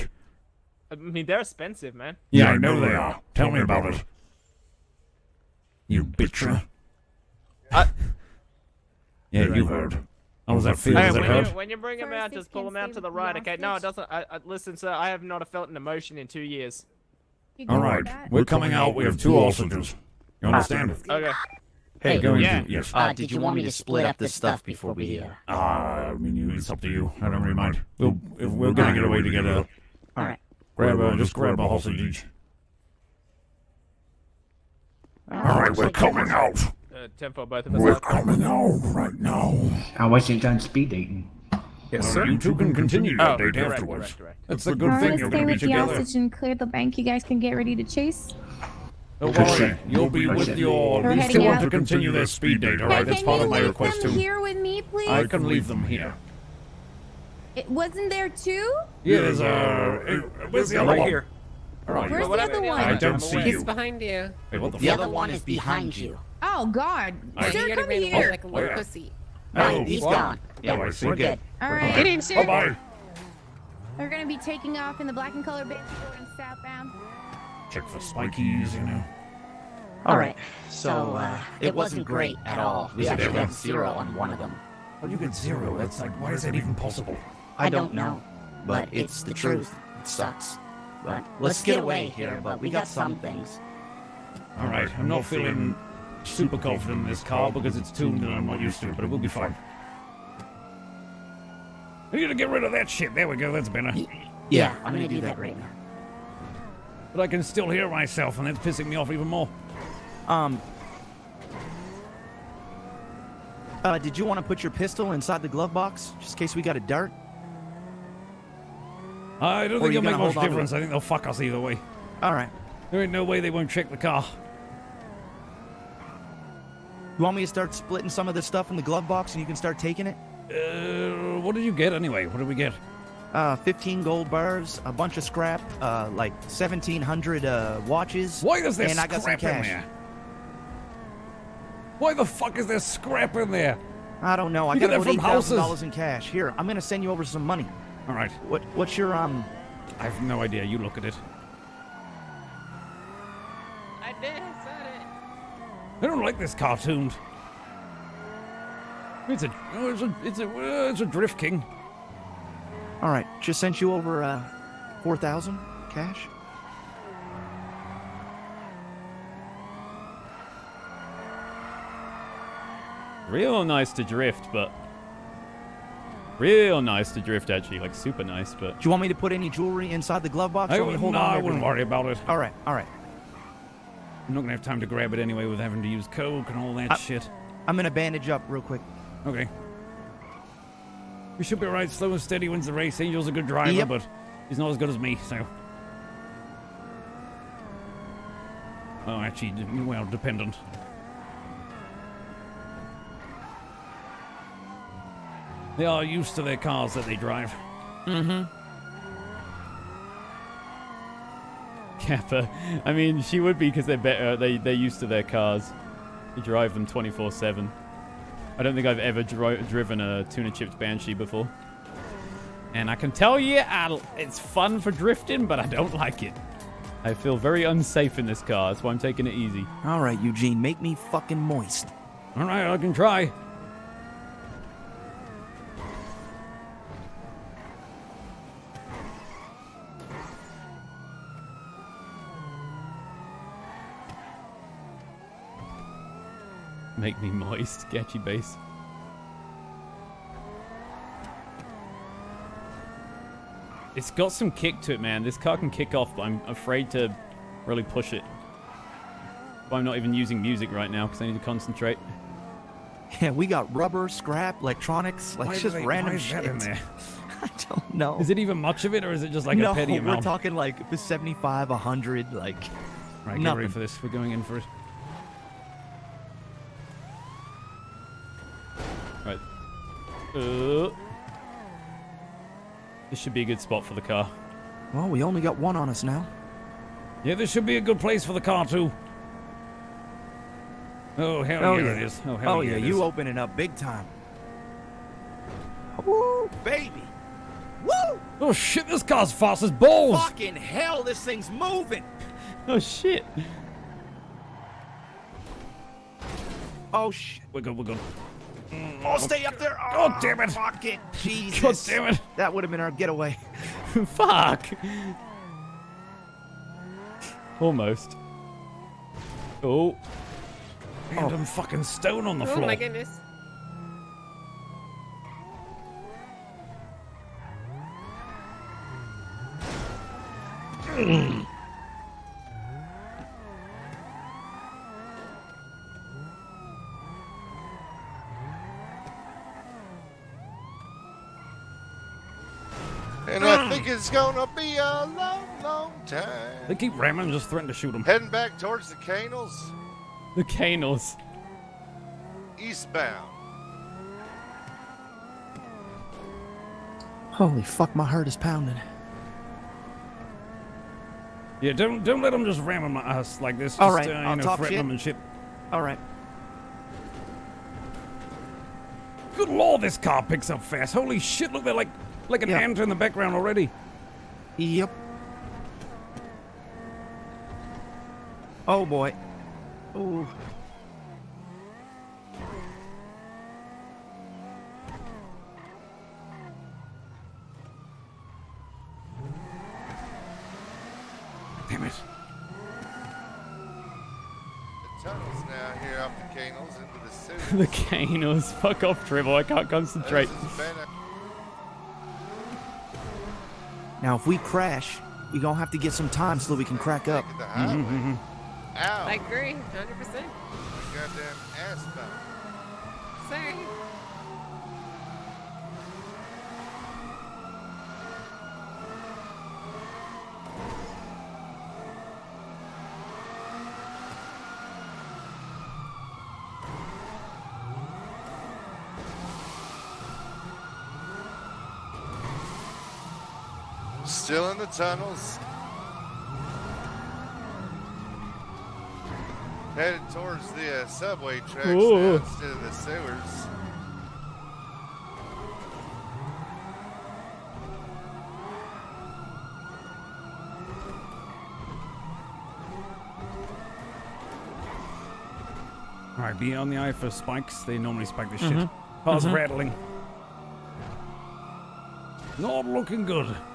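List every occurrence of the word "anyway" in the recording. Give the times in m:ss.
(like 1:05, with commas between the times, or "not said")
2:11, 3:05.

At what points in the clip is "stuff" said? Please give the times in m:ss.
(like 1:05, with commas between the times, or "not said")
0:24, 2:08.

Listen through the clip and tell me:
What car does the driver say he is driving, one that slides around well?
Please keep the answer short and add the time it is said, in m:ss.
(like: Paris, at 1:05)
drift king, at 2:41.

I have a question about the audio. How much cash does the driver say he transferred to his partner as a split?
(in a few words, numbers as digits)
$4,000.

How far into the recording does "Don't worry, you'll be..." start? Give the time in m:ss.
0:49.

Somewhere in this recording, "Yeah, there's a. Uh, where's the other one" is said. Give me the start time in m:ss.
0:59.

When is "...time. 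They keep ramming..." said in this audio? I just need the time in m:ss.
5:46.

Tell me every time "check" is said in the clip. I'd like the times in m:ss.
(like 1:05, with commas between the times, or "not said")
1:17, 2:03.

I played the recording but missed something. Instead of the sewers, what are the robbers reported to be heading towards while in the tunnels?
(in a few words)
subway tracks.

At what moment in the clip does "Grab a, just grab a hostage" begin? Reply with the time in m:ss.
0:30.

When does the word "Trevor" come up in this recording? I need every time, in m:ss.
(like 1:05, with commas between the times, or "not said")
6:39.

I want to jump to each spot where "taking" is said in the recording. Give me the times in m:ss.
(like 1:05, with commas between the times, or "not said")
1:14, 2:09, 3:48.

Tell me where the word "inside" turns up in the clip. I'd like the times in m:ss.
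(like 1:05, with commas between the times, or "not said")
1:55, 2:59.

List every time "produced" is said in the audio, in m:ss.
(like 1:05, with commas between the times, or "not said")
not said.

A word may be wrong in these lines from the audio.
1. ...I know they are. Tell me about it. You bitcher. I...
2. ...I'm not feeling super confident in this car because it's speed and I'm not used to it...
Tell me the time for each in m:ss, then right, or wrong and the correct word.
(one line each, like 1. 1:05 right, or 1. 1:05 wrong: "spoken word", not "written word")
1. 0:02 right
2. 1:34 wrong: "tuned", not "speed".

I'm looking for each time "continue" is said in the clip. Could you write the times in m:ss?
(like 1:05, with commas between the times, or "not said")
0:42, 0:51.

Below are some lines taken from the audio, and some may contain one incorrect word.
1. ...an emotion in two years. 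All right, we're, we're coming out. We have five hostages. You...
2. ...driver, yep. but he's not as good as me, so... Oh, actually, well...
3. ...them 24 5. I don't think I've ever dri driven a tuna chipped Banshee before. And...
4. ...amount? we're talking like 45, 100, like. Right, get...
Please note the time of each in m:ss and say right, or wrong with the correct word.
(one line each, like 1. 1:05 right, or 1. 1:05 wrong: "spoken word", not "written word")
1. 0:15 wrong: "two", not "five"
2. 3:13 right
3. 3:36 wrong: "7", not "5"
4. 4:29 wrong: "75", not "45".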